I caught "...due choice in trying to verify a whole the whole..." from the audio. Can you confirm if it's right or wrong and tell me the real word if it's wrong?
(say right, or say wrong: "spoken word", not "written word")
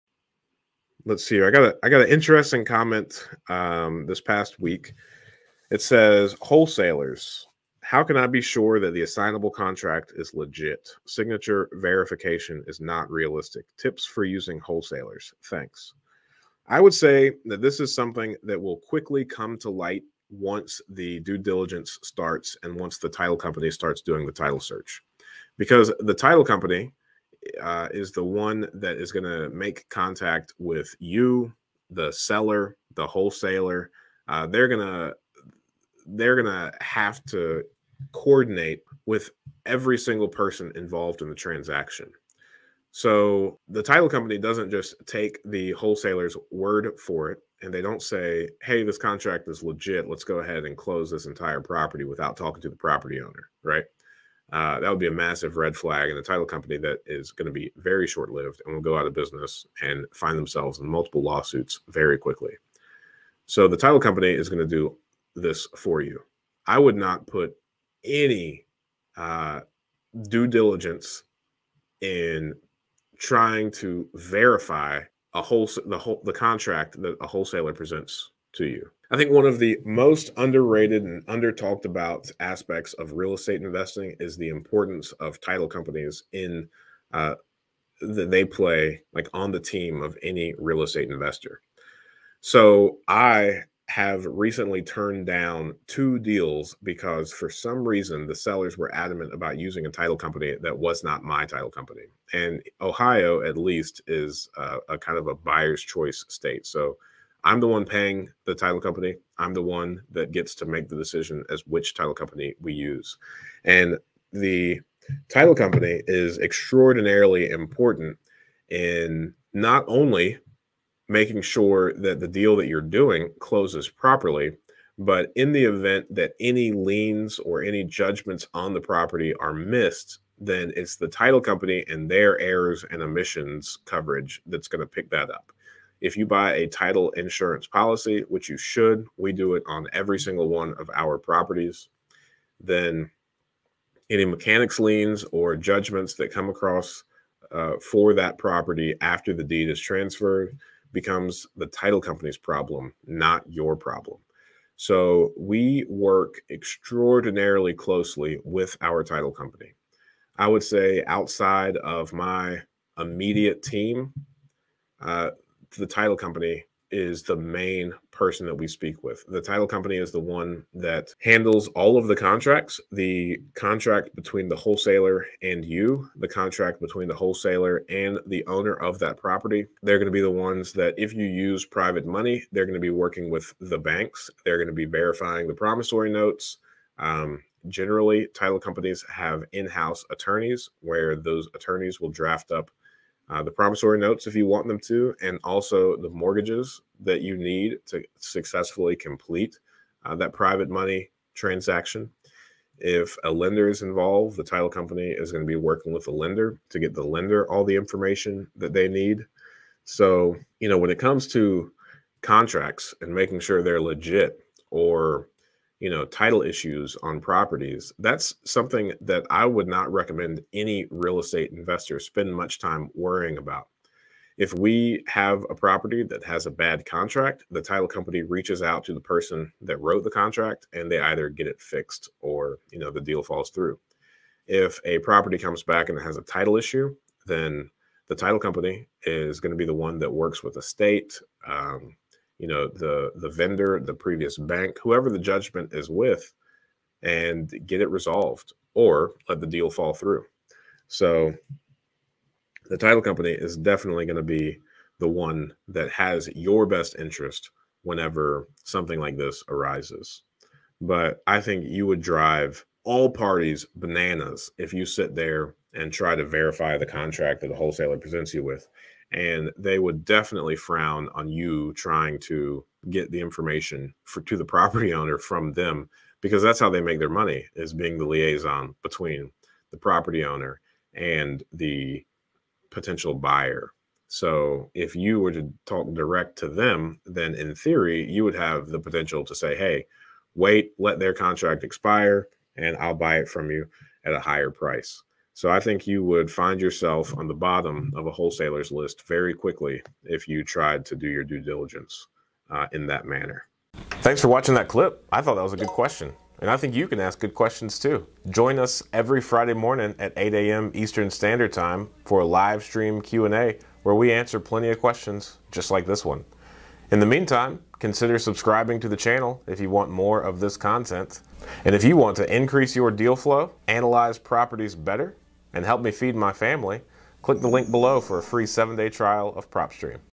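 wrong: "diligence", not "choice".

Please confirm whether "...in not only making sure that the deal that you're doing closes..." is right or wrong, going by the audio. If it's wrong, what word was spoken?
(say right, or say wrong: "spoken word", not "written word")
right.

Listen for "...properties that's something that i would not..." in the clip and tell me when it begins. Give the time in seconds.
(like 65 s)
217 s.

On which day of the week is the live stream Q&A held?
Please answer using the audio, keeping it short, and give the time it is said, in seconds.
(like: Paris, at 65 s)
Friday, at 309 s.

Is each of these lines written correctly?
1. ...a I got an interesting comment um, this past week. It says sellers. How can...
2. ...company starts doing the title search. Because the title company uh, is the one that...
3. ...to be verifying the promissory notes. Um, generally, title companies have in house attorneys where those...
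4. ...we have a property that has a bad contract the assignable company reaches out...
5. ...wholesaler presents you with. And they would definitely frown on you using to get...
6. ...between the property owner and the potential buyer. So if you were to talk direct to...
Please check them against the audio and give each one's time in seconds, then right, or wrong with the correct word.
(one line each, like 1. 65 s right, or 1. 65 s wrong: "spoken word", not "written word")
1. 1 s wrong: "wholesalers", not "sellers"
2. 23 s right
3. 184 s right
4. 224 s wrong: "title", not "assignable"
5. 267 s wrong: "trying", not "using"
6. 278 s right.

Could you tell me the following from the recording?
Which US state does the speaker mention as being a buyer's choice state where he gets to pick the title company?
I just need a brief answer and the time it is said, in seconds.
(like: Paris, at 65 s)
Ohio, at 102 s.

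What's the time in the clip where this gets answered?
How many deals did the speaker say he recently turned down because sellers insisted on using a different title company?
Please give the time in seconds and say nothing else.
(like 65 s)
95 s.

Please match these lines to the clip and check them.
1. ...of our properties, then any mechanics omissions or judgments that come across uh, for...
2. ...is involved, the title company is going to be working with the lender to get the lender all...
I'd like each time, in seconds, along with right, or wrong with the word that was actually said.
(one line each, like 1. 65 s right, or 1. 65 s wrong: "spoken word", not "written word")
1. 140 s wrong: "liens", not "omissions"
2. 203 s right.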